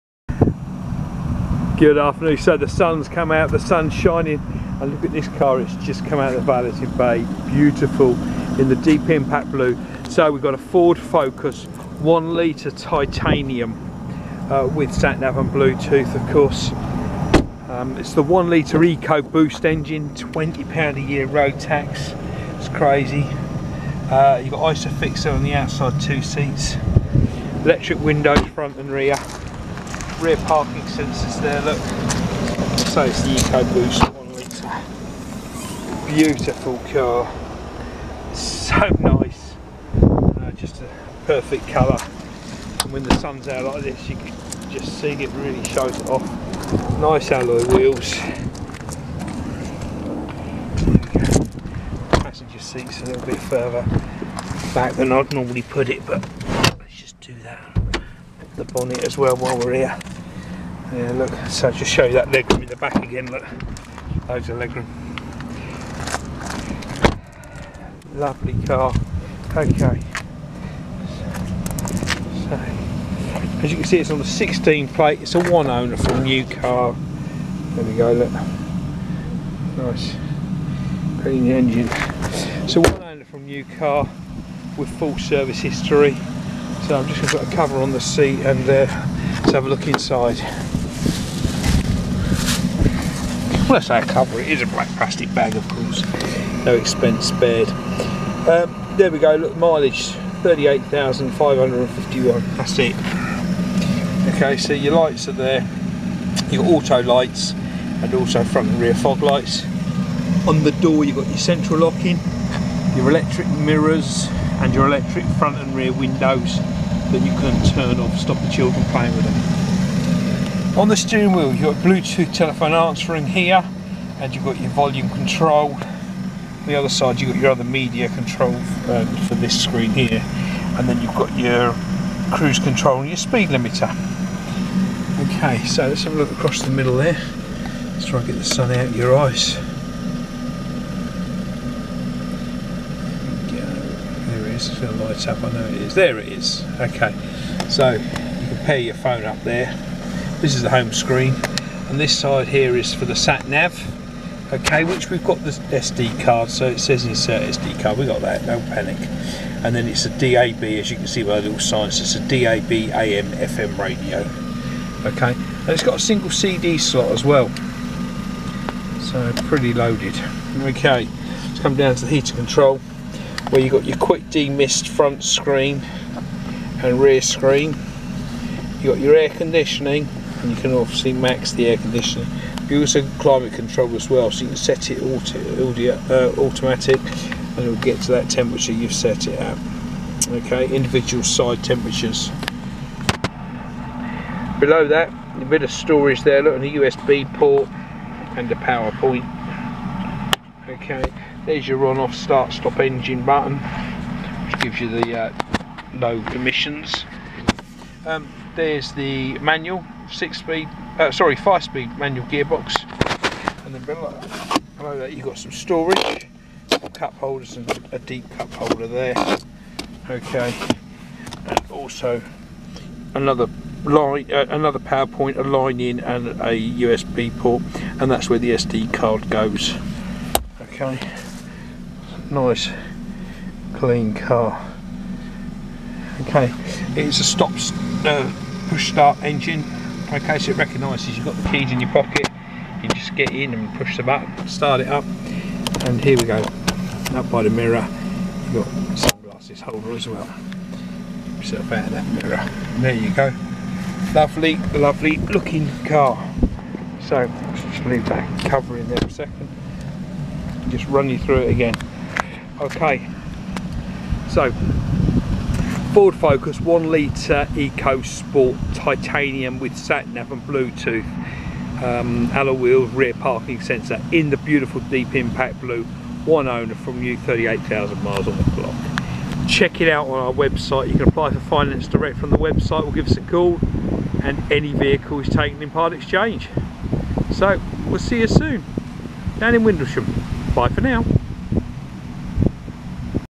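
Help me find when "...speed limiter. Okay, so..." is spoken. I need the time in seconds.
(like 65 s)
133 s.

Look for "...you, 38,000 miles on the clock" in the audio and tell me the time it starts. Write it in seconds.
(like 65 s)
277 s.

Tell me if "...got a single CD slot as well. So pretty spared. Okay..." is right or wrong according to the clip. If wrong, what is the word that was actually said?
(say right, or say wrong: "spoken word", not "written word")
wrong: "loaded", not "spared".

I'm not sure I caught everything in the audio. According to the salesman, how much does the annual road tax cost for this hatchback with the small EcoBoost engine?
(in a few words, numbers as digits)
£20.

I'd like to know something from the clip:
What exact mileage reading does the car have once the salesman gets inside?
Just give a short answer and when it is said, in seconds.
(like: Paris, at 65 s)
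38,551, at 100 s.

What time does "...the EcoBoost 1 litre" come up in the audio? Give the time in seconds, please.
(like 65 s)
33 s.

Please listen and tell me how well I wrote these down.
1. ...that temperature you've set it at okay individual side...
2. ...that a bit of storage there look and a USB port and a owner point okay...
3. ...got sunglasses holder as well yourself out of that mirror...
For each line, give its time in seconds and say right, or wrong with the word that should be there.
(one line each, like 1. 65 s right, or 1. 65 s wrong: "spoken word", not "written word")
1. 188 s right
2. 194 s wrong: "power", not "owner"
3. 248 s right.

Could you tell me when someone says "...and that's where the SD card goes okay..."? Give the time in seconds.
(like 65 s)
227 s.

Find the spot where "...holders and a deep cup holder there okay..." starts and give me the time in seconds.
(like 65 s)
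217 s.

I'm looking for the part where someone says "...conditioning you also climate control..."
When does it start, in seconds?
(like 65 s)
181 s.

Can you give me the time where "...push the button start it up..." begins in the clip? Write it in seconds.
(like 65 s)
243 s.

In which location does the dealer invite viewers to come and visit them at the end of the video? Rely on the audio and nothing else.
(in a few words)
Windlesham.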